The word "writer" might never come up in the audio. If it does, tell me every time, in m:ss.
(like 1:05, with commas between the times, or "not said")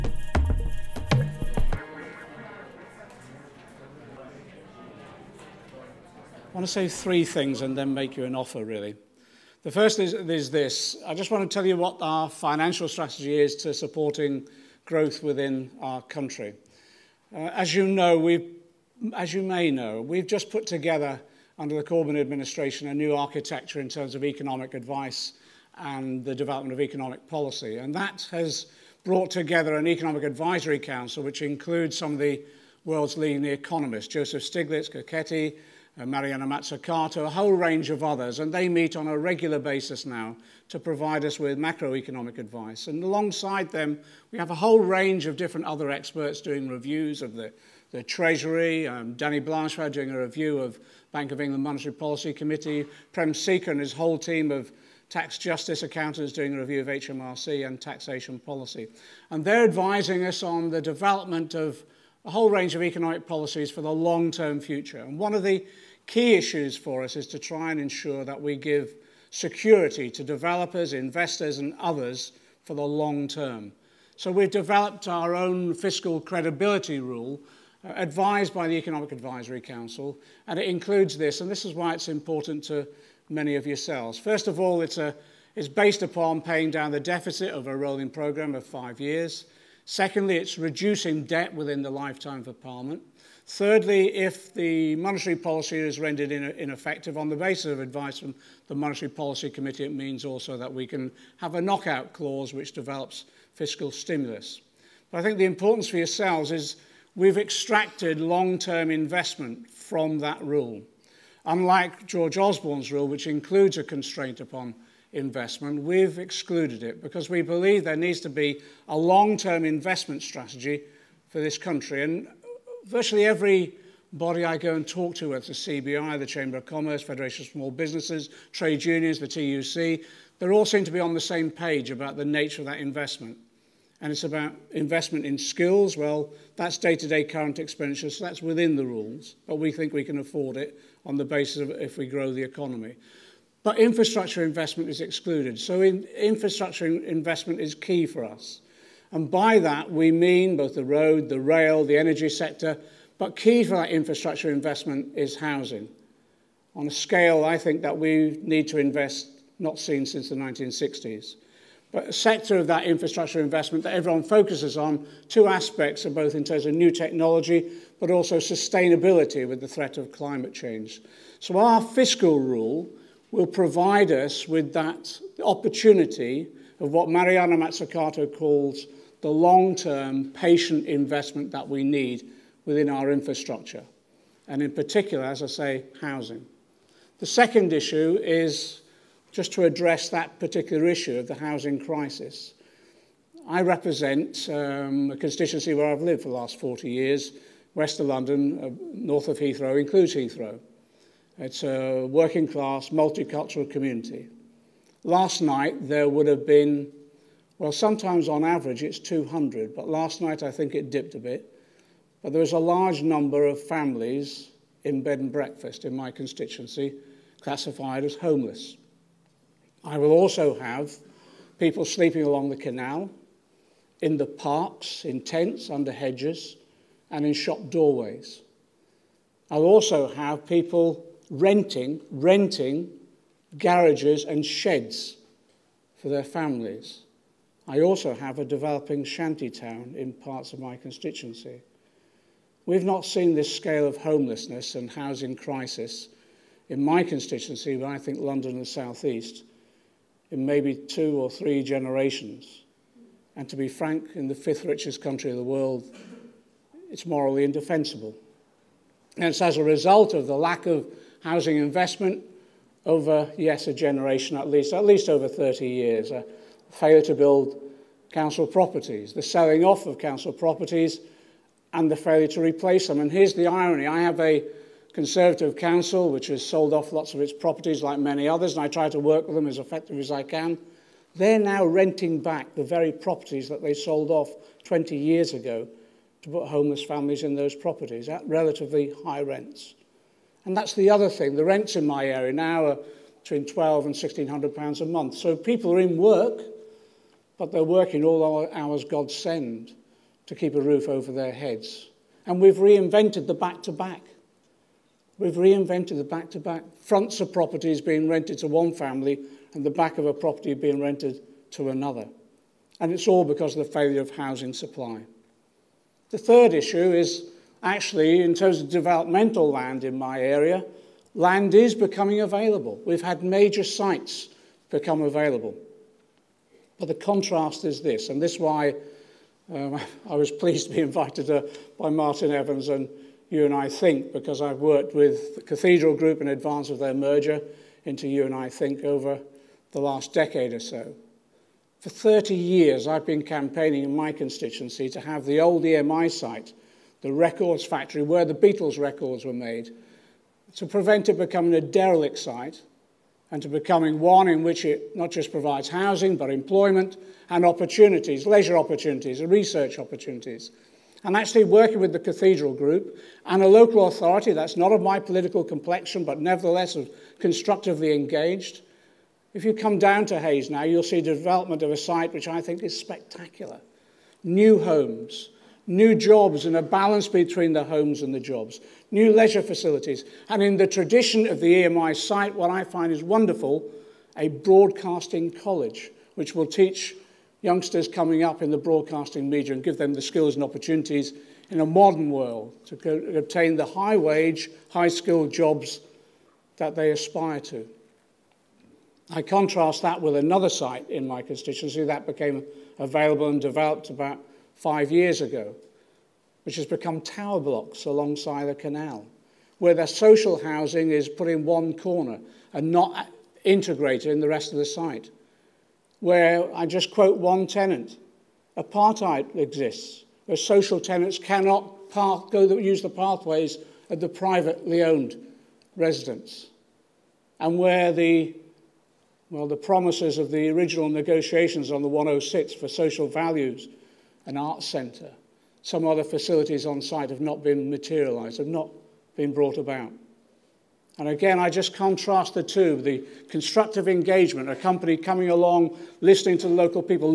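not said.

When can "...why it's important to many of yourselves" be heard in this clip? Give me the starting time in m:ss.
1:21.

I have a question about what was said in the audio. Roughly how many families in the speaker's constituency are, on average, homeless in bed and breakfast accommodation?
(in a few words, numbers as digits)
200.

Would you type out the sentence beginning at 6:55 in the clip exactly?
Where I just quote one tenant, apartheid exists, where social tenants cannot go use the pathways of the privately owned residents.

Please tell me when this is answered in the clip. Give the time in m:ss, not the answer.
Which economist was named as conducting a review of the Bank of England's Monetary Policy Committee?
0:49.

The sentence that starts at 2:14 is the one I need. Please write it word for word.
And it's about investment in skills.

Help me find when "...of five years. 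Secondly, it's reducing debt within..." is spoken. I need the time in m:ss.
1:28.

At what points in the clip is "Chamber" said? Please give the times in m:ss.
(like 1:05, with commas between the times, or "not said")
2:06.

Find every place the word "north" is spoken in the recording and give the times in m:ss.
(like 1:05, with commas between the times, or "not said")
3:18.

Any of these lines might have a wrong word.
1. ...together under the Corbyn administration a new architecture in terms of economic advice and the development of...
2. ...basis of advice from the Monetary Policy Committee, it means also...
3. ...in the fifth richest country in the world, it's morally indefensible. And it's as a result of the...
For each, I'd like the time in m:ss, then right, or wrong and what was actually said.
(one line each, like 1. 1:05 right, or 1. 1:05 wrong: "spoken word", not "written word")
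1. 0:20 right
2. 1:37 right
3. 4:14 right.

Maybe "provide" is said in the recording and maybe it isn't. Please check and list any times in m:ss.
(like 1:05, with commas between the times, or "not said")
0:40, 2:53, 5:55.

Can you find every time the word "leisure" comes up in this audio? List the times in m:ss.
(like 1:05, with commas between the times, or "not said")
5:58, 6:19.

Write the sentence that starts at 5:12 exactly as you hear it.
And it's all because of the failure of housing supply.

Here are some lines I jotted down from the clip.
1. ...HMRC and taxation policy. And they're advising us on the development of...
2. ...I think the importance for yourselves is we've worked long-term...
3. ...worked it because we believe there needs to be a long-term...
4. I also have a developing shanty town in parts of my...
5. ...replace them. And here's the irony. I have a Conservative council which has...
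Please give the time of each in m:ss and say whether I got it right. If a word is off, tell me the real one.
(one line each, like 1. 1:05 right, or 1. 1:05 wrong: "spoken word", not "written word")
1. 0:56 right
2. 1:45 wrong: "extracted", not "worked"
3. 1:56 wrong: "excluded", not "worked"
4. 3:57 right
5. 4:32 right.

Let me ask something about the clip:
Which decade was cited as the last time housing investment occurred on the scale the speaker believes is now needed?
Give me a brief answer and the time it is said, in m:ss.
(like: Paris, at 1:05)
1960s, at 2:40.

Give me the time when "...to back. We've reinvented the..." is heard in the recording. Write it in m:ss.
5:03.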